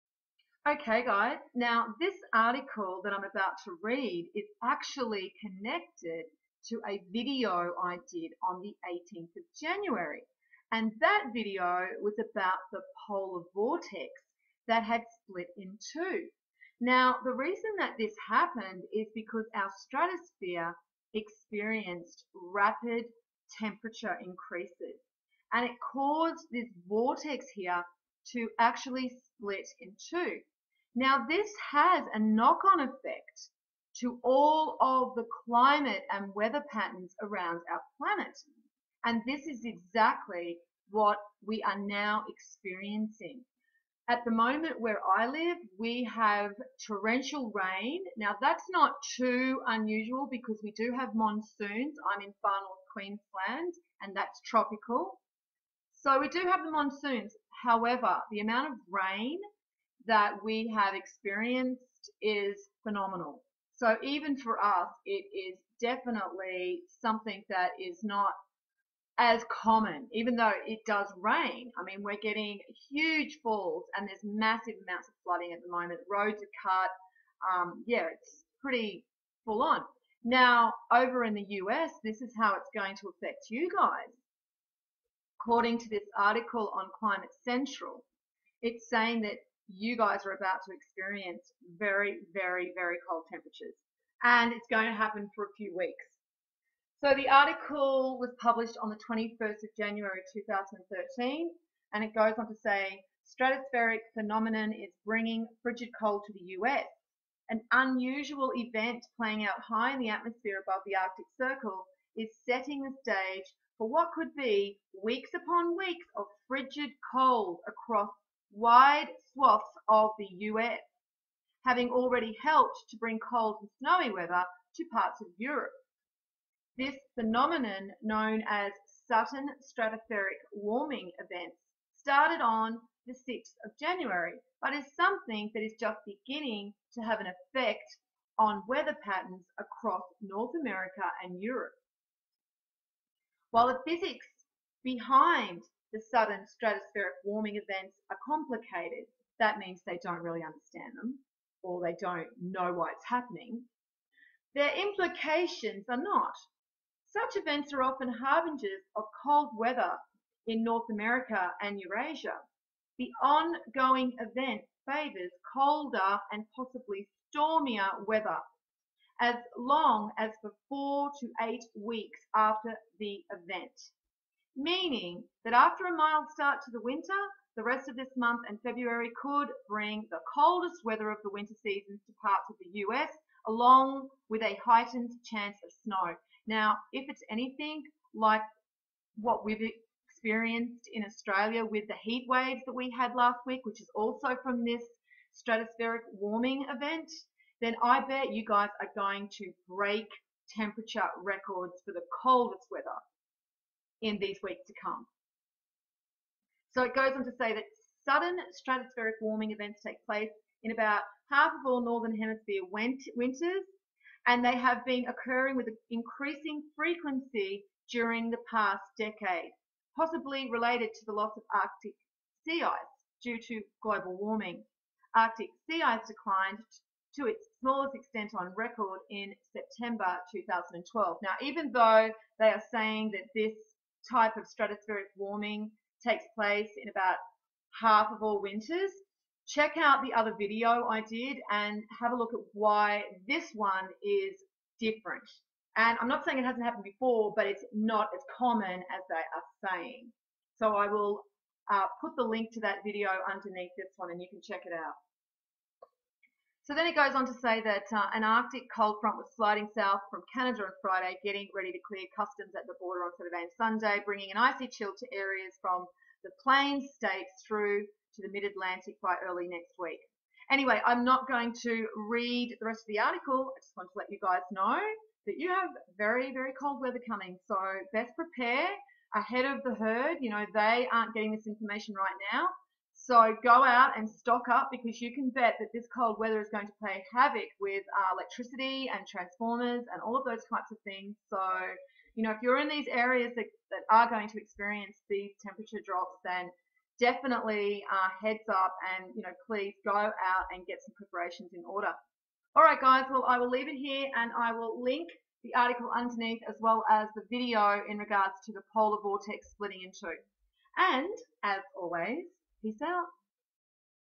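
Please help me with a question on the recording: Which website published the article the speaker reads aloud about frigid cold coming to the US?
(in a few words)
Climate Central.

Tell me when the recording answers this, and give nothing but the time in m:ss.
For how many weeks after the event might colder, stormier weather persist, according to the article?
2:50.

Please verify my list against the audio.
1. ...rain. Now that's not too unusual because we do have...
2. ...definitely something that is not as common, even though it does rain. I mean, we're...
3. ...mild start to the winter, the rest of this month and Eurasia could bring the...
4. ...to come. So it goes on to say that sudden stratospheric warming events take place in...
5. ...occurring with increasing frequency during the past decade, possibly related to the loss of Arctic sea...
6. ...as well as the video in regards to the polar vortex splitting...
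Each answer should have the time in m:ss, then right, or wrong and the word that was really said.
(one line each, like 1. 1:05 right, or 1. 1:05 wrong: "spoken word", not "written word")
1. 0:47 right
2. 1:05 right
3. 2:55 wrong: "February", not "Eurasia"
4. 3:24 right
5. 3:35 right
6. 5:06 right.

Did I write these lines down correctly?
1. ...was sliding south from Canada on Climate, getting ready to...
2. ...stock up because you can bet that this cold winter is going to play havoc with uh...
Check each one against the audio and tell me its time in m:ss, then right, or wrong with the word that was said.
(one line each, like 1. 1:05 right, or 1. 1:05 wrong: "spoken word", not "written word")
1. 4:19 wrong: "Friday", not "Climate"
2. 4:44 wrong: "weather", not "winter".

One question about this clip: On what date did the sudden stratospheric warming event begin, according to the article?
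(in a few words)
6th of January.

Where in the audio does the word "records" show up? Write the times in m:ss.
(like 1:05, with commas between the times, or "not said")
3:21, 3:48.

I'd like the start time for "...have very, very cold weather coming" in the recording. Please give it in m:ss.
4:35.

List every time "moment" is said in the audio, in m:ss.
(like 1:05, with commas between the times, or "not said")
0:44, 1:15.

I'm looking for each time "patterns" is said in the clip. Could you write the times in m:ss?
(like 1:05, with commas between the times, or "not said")
0:36, 2:19.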